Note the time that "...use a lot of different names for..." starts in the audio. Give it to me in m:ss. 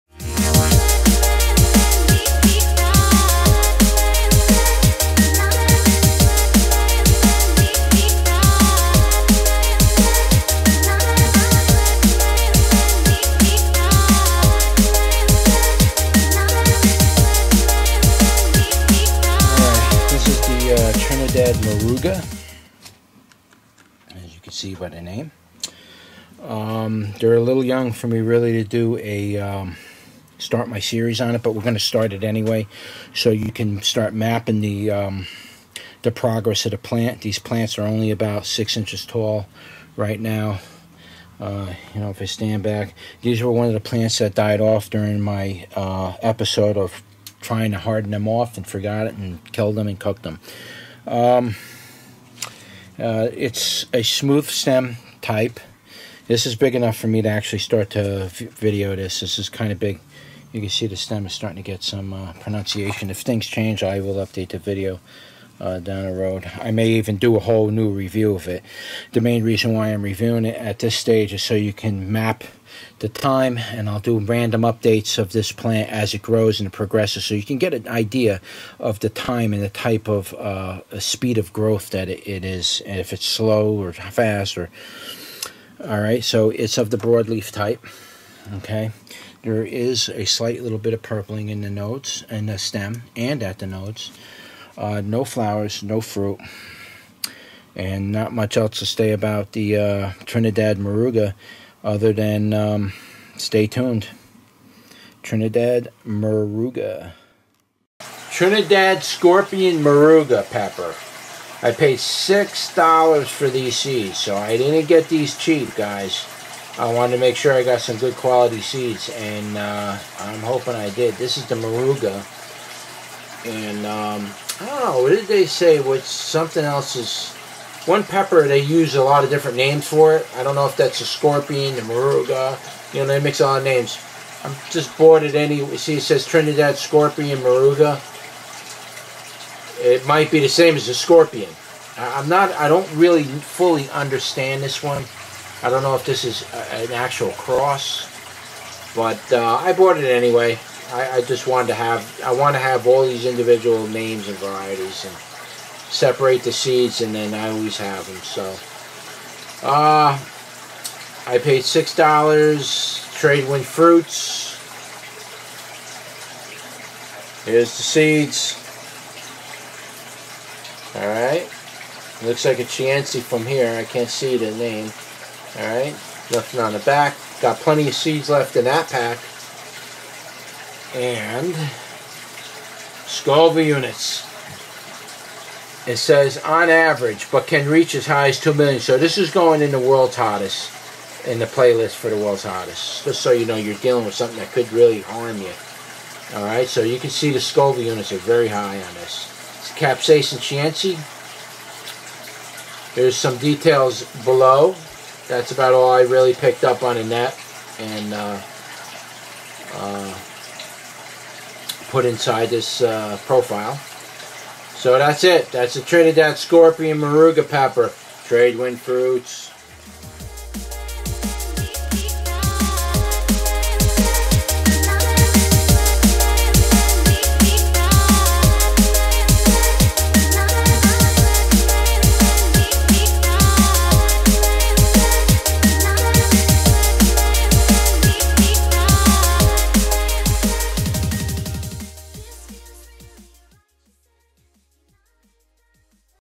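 2:08.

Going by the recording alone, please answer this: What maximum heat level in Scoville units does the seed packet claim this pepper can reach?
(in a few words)
2 million.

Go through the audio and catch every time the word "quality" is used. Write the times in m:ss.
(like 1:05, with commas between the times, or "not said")
1:58.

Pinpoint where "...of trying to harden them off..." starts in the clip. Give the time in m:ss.
0:46.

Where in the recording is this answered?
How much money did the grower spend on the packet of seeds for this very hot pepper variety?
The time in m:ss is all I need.
1:51.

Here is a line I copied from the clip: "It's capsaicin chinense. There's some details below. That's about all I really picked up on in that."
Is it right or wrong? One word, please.
right.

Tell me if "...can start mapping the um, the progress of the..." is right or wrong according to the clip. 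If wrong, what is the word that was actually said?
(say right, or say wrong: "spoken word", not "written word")
right.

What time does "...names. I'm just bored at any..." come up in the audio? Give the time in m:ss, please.
2:13.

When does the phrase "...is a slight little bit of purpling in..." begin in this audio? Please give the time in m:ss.
1:29.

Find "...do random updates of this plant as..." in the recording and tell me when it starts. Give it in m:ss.
1:13.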